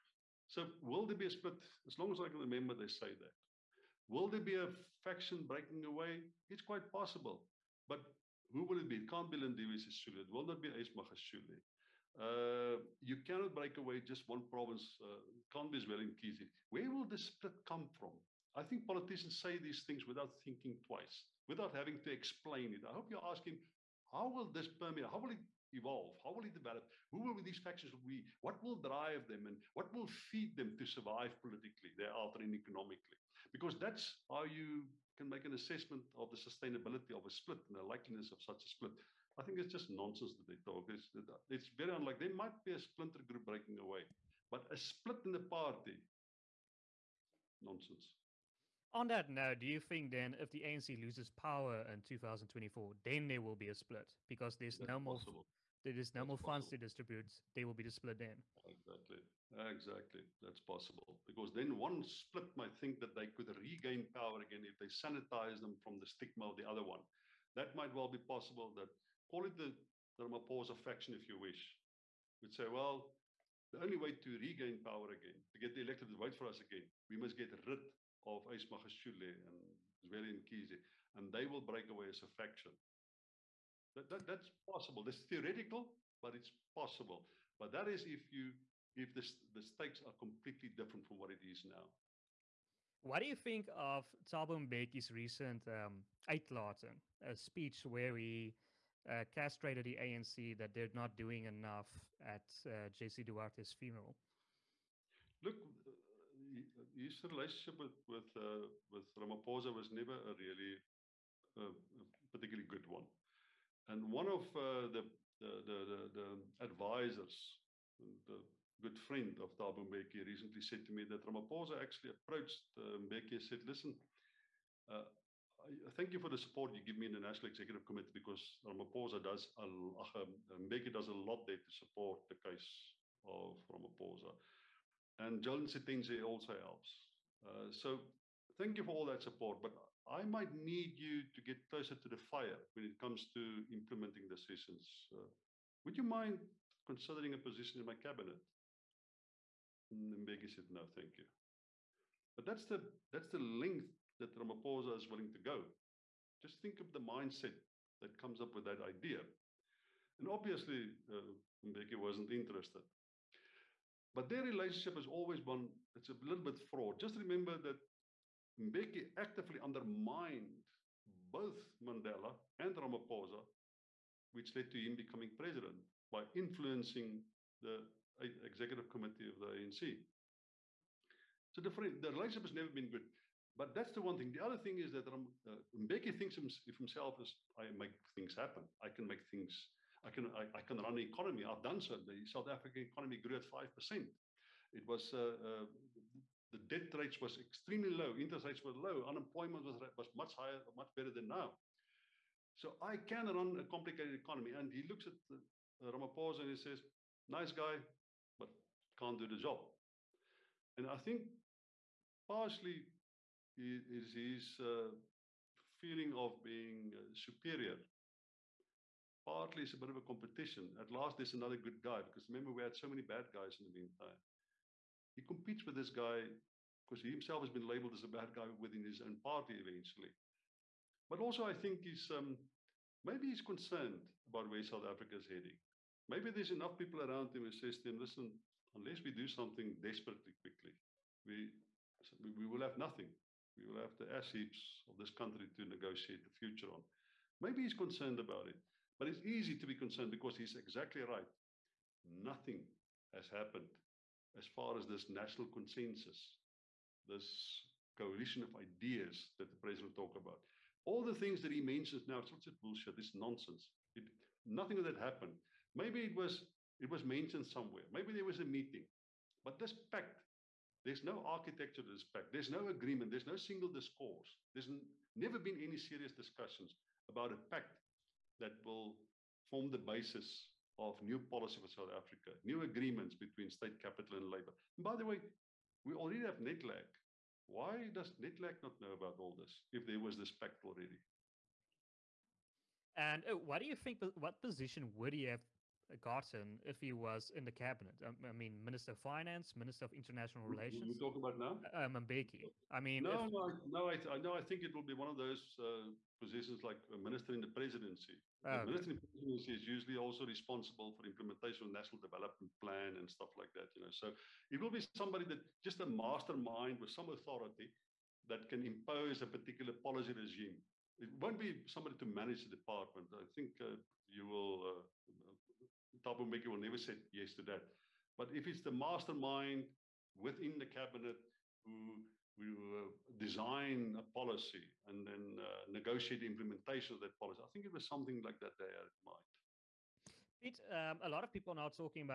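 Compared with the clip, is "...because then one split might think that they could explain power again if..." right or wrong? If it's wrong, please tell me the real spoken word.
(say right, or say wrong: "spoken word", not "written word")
wrong: "regain", not "explain".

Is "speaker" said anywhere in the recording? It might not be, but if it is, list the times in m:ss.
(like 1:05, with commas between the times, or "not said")
not said.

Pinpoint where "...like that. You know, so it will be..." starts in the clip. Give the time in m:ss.
5:13.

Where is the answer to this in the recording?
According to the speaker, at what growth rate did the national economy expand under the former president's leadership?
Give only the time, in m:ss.
3:13.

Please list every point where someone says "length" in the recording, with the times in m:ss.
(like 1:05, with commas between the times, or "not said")
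2:33.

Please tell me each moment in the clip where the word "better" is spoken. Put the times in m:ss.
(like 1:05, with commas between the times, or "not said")
3:20.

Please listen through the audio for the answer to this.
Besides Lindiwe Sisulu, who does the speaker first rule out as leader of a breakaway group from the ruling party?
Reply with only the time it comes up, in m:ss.
0:10.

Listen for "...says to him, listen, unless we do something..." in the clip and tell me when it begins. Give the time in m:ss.
3:57.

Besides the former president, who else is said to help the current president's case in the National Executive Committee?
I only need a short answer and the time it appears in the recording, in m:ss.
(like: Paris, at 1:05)
Joel Netshitenzhe, at 2:15.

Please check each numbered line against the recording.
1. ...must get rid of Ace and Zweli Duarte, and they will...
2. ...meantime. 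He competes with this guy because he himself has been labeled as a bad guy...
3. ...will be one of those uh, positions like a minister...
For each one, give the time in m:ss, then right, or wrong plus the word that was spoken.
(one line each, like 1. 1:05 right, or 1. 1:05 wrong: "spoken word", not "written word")
1. 1:17 wrong: "Mkhize", not "Duarte"
2. 3:43 right
3. 5:04 right.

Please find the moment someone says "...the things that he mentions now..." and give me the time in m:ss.
4:21.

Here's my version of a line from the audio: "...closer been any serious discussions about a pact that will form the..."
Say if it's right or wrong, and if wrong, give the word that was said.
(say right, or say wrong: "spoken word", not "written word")
wrong: "never", not "closer".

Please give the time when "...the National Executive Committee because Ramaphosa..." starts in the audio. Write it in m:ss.
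2:07.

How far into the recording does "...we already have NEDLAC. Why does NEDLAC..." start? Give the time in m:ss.
4:45.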